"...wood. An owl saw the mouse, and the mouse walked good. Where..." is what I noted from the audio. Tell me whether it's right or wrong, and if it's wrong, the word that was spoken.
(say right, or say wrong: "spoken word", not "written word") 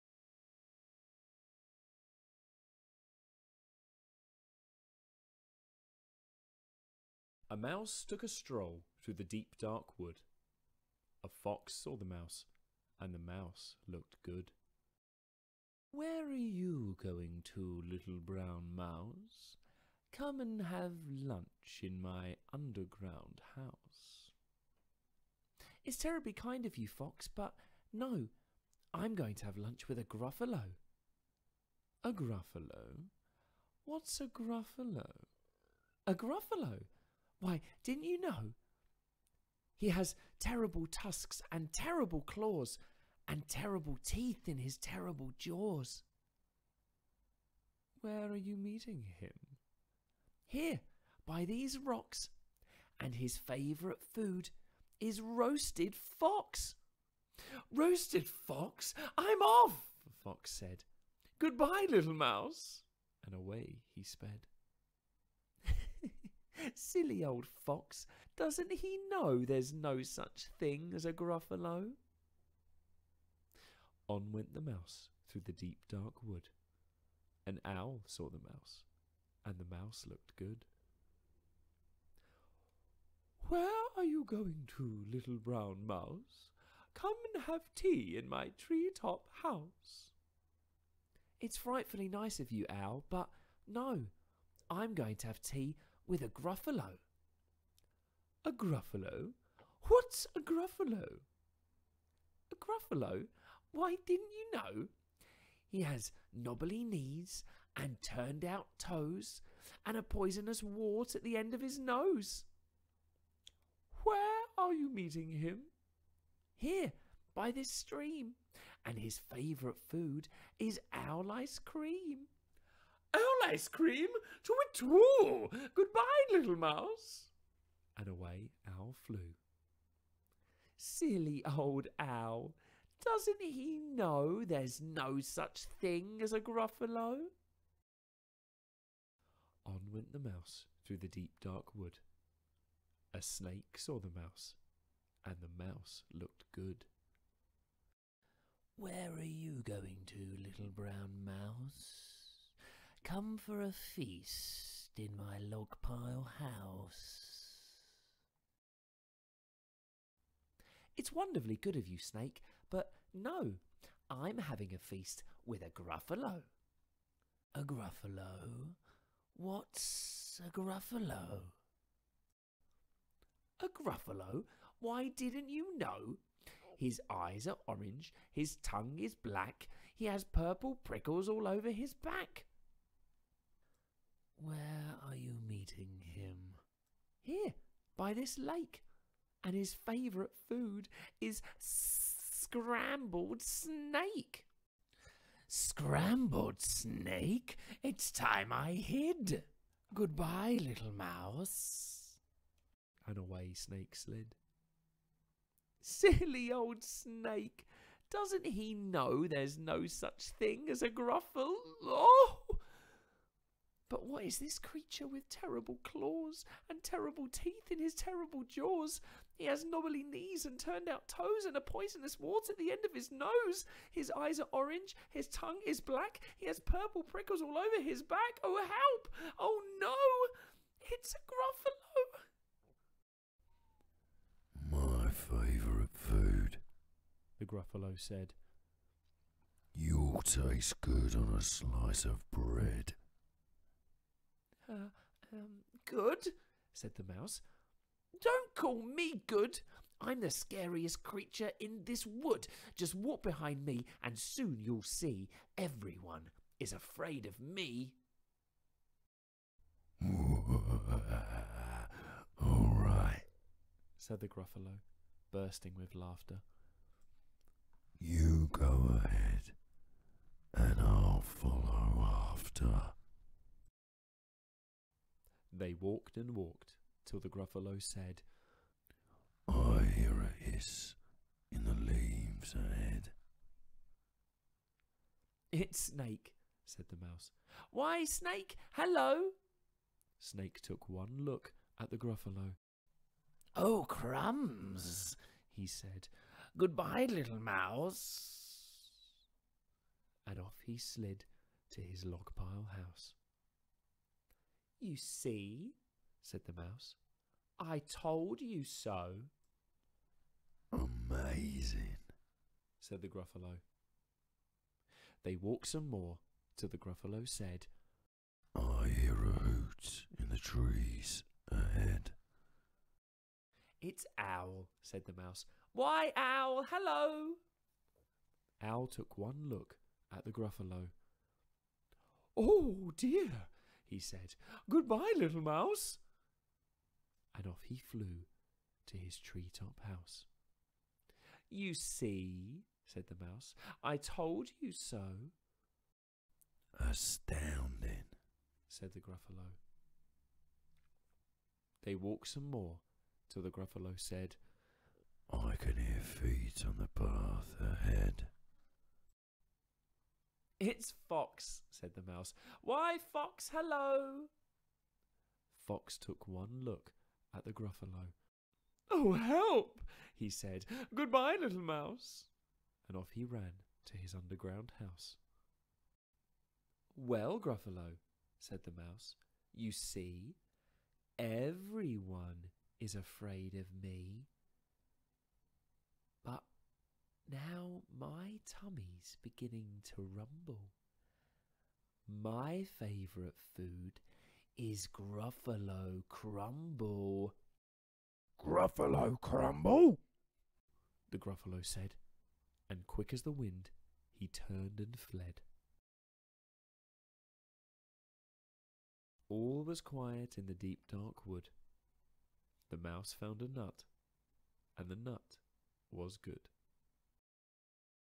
wrong: "looked", not "walked".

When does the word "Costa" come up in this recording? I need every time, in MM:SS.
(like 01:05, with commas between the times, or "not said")
not said.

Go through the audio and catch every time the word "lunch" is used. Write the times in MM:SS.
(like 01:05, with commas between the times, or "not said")
00:21, 00:29.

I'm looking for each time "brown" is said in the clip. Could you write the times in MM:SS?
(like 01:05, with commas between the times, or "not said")
00:18, 01:25, 02:30.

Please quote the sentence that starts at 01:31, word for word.
It's frightfully nice of you, Owl, but no, I'm going to have tea with a gruffalo.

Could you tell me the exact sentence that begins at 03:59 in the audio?
You'll taste good on a slice of bread.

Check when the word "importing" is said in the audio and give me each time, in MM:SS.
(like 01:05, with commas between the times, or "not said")
not said.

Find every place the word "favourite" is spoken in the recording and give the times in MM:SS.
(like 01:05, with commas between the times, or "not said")
00:53, 01:59, 03:09, 03:55, 06:32.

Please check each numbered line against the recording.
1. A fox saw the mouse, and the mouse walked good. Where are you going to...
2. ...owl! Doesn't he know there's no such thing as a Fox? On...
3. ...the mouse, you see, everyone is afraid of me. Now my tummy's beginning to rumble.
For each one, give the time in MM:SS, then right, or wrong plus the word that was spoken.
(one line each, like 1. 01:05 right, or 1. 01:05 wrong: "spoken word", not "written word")
1. 00:11 wrong: "looked", not "walked"
2. 02:11 wrong: "Gruffalo", not "Fox"
3. 06:18 right.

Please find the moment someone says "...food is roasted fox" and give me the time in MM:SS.
00:54.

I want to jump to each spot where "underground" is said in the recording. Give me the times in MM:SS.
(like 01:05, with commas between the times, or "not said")
00:22, 06:14.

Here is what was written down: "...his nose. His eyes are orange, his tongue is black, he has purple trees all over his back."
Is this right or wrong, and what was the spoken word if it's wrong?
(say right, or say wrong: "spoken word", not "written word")
wrong: "prickles", not "trees".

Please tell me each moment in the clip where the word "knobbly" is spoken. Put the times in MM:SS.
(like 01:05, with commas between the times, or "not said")
01:46, 03:39.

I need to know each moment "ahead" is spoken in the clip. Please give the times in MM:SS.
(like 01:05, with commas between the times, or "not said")
04:29, 04:42, 05:21, 05:57.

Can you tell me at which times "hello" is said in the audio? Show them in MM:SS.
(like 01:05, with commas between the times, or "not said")
04:48, 05:26, 06:03.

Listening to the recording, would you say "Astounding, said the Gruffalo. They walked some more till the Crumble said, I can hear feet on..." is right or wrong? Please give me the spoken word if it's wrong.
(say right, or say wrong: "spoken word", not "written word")
wrong: "Gruffalo", not "Crumble".